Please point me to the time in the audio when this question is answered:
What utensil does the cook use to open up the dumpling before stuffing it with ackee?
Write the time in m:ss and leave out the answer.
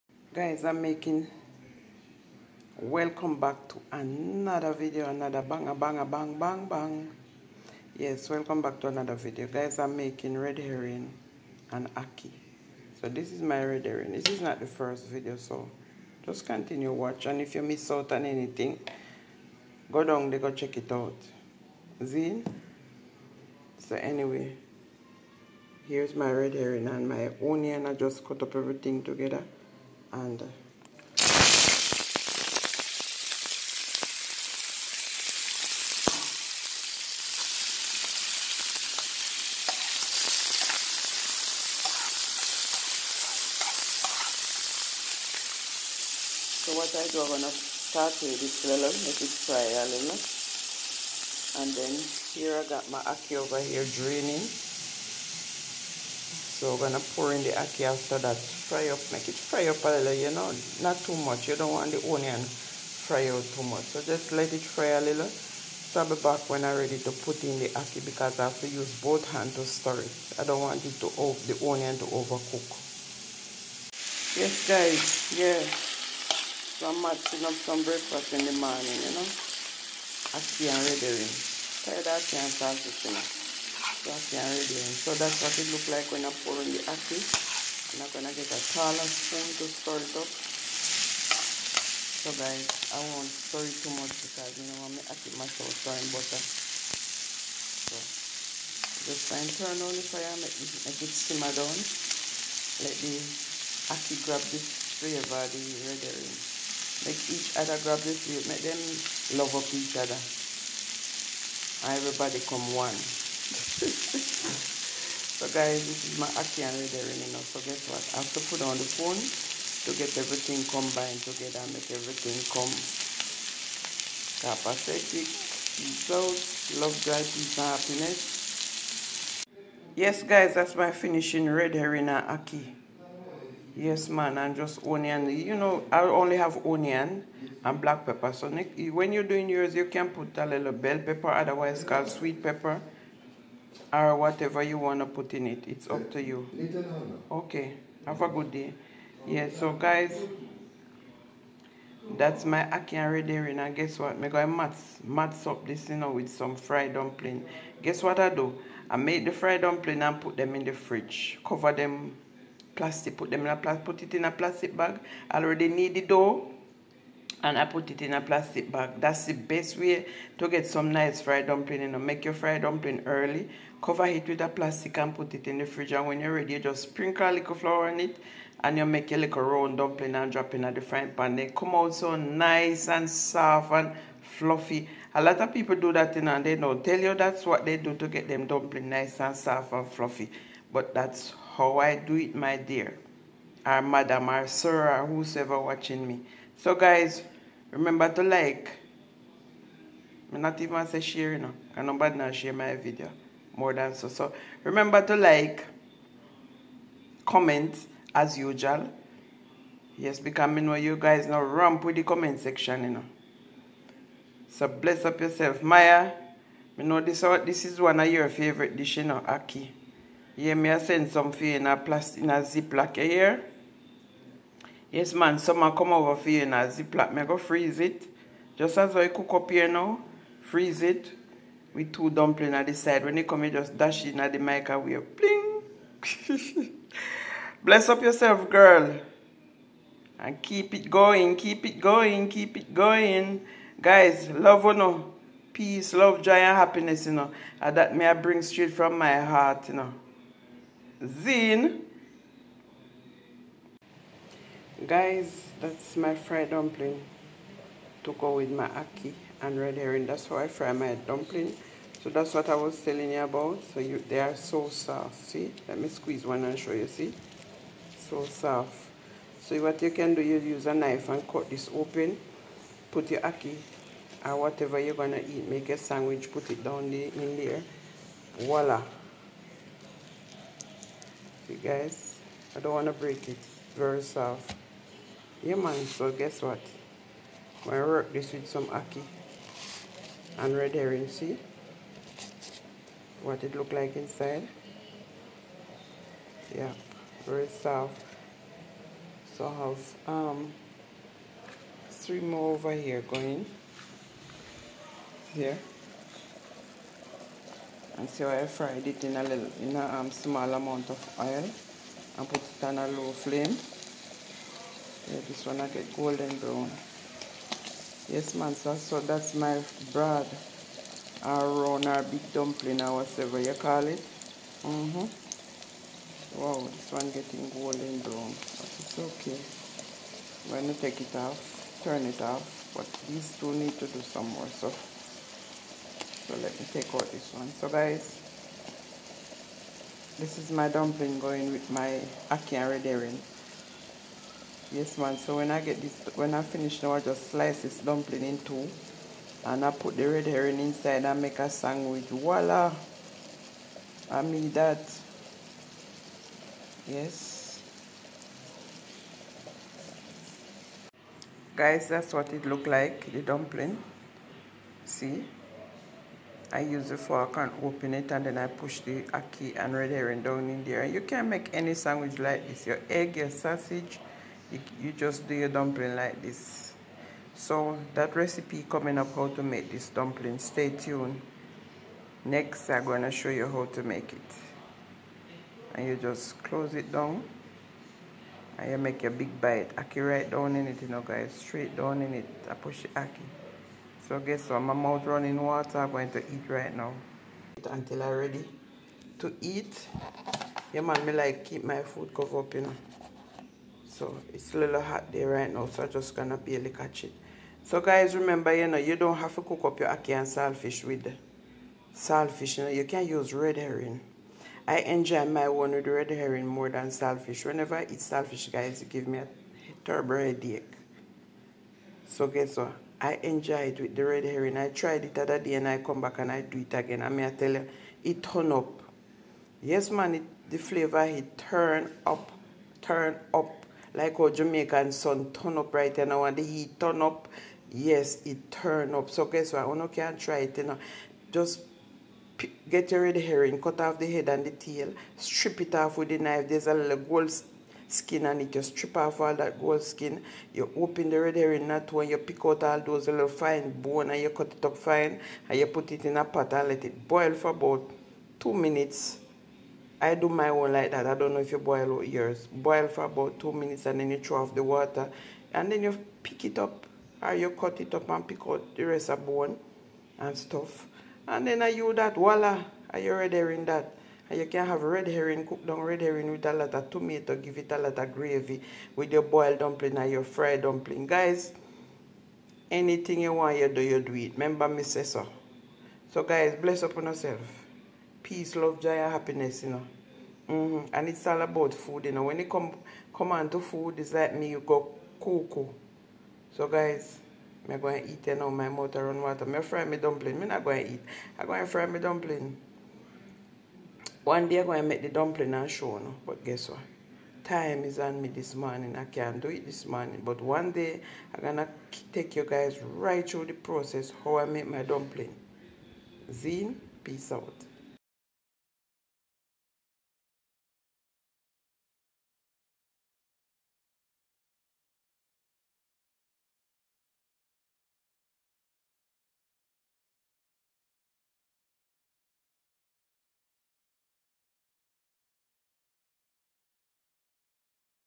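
6:06.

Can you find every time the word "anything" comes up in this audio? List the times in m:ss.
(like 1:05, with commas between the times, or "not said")
0:18, 8:02.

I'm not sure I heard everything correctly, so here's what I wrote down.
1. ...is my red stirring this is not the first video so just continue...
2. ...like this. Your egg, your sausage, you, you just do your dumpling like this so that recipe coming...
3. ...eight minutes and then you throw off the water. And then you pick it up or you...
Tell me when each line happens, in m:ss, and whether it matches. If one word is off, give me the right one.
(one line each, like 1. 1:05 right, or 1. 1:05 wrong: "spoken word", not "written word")
1. 0:13 wrong: "herring", not "stirring"
2. 6:12 right
3. 7:43 wrong: "two", not "eight".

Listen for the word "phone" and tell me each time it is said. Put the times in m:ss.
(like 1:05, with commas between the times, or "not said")
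1:58.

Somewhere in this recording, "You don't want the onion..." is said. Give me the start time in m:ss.
1:01.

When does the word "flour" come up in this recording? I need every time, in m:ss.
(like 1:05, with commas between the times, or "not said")
2:57.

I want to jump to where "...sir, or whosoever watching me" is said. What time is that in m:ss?
3:14.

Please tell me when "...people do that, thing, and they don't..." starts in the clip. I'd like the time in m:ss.
3:05.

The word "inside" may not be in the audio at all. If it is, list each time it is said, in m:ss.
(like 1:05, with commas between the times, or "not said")
4:53, 5:50.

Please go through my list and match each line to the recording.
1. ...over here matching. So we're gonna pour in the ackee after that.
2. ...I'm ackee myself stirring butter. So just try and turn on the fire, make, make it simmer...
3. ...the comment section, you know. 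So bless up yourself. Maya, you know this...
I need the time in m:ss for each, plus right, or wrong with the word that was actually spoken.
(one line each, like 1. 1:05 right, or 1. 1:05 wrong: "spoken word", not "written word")
1. 0:53 wrong: "draining", not "matching"
2. 1:34 right
3. 3:31 right.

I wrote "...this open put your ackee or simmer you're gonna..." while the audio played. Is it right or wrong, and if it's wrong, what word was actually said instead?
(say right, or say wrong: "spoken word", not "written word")
wrong: "whatever", not "simmer".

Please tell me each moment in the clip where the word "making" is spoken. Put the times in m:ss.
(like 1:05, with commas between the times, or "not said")
0:00, 0:09.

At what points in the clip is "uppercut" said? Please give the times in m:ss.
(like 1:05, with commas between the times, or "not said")
not said.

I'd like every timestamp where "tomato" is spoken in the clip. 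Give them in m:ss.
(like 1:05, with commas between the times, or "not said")
7:56.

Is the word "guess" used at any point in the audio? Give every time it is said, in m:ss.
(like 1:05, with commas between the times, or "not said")
1:57, 2:33, 2:37, 4:46, 6:34, 7:02, 7:19, 8:26.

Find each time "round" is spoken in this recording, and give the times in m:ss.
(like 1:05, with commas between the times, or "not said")
2:59, 5:21.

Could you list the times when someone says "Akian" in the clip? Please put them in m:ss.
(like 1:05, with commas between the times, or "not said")
1:56.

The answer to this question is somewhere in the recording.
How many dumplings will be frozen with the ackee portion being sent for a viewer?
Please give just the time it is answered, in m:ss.
3:51.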